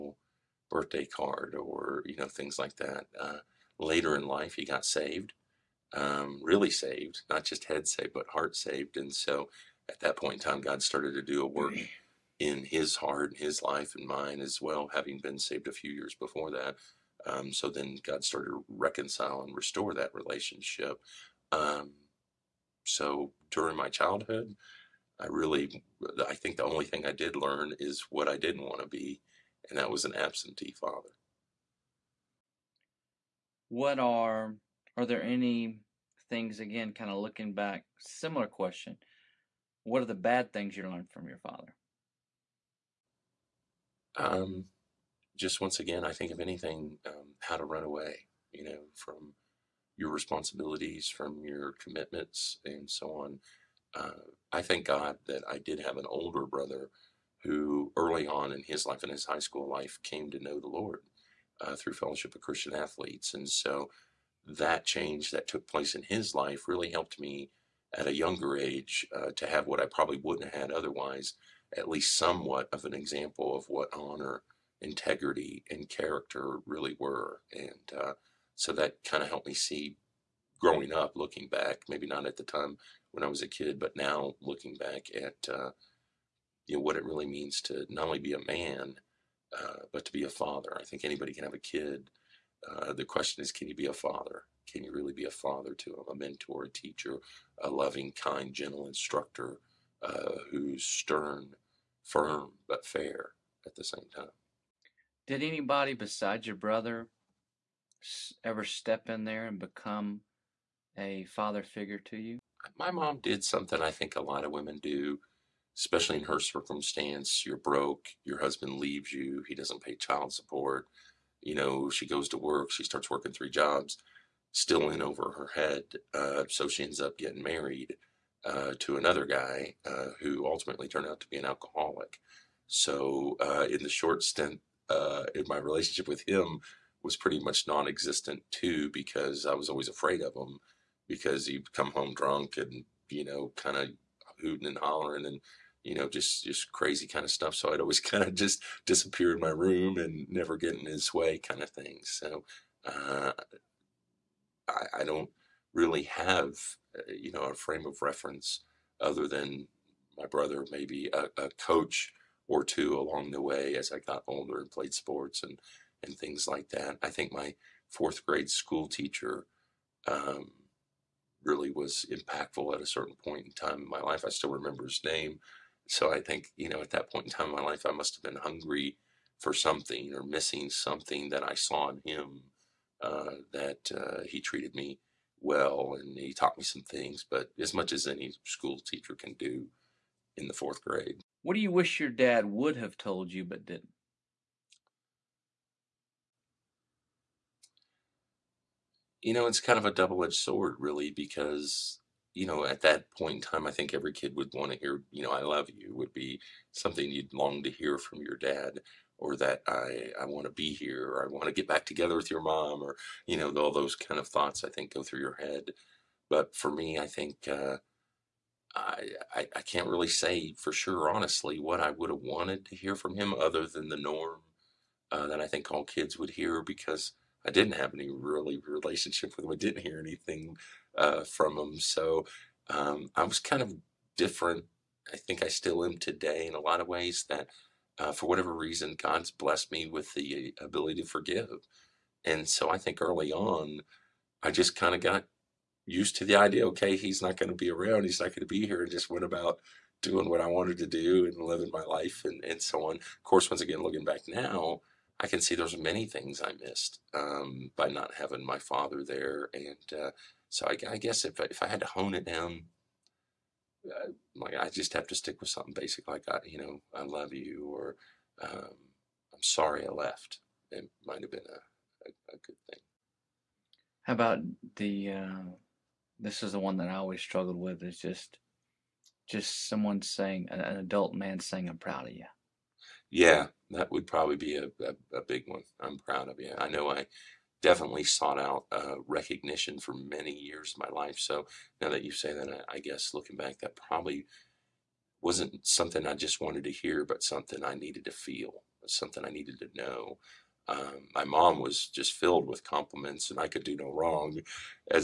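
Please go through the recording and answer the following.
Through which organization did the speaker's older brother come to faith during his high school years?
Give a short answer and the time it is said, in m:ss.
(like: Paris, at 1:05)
Fellowship of Christian Athletes, at 1:01.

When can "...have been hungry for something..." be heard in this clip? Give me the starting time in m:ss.
2:58.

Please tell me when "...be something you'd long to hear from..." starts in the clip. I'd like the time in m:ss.
3:26.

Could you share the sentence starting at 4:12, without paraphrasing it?
Of course, once again, looking back now, I can see there's many things I missed um, by not having my father there.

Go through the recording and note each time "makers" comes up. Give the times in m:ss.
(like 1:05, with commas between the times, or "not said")
not said.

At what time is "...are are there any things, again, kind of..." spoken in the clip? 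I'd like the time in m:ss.
0:33.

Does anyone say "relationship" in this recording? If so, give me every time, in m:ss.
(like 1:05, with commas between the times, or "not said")
0:20, 2:15, 3:48.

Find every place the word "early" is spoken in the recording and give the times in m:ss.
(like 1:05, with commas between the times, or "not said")
0:57, 4:03.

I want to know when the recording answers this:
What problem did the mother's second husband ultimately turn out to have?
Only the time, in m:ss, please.
2:11.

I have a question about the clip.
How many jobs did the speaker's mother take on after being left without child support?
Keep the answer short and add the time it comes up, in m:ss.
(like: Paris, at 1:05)
3, at 2:03.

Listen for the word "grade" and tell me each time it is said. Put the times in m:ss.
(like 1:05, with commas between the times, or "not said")
2:48, 3:10.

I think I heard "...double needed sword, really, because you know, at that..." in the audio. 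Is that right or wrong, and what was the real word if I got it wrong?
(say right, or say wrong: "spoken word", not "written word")
wrong: "edged", not "needed".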